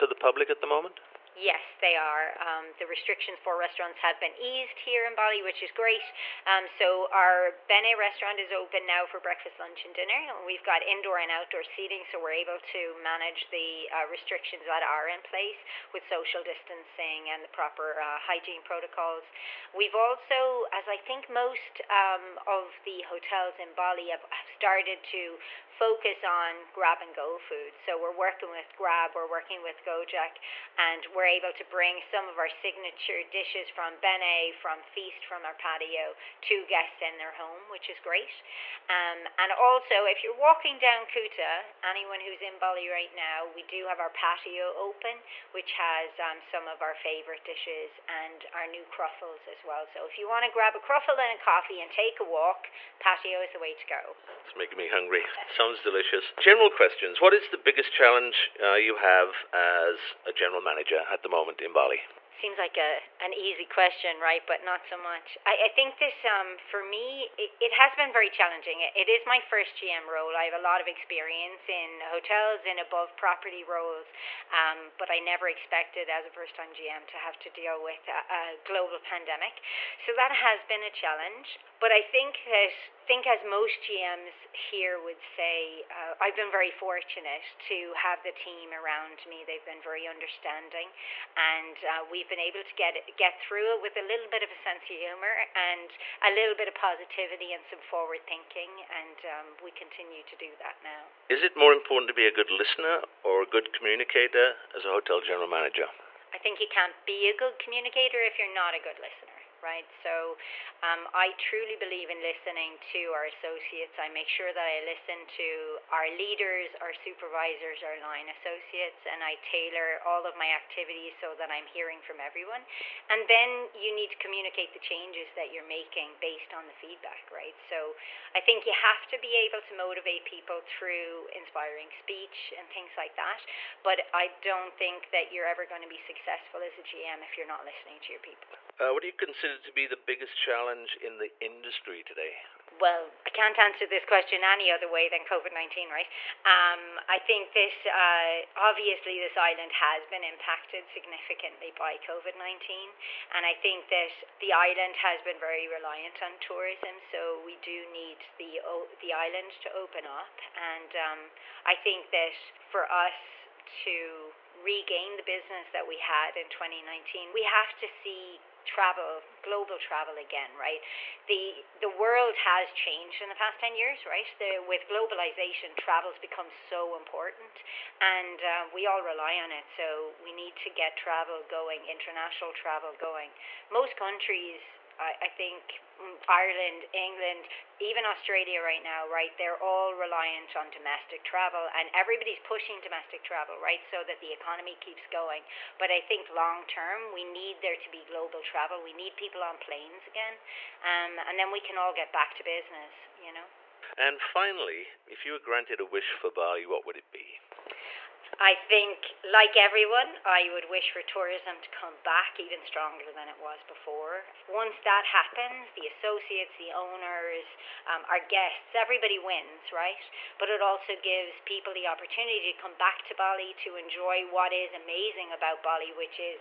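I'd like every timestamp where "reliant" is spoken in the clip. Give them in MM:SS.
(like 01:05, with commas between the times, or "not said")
02:35, 03:09.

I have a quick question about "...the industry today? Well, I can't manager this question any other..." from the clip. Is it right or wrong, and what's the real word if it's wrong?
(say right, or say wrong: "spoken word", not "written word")
wrong: "answer", not "manager".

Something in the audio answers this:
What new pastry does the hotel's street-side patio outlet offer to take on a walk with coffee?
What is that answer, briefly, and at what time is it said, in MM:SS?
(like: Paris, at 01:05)
cruffles, at 00:48.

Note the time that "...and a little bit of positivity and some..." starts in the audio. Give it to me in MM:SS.
01:35.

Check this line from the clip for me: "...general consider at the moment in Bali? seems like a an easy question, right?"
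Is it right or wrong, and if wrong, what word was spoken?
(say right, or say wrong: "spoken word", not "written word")
wrong: "manager", not "consider".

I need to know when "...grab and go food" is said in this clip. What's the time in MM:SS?
00:26.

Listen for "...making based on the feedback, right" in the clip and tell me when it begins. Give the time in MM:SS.
02:05.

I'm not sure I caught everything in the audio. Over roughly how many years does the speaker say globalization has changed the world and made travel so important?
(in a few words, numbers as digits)
10 years.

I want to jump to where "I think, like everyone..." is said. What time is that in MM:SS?
03:28.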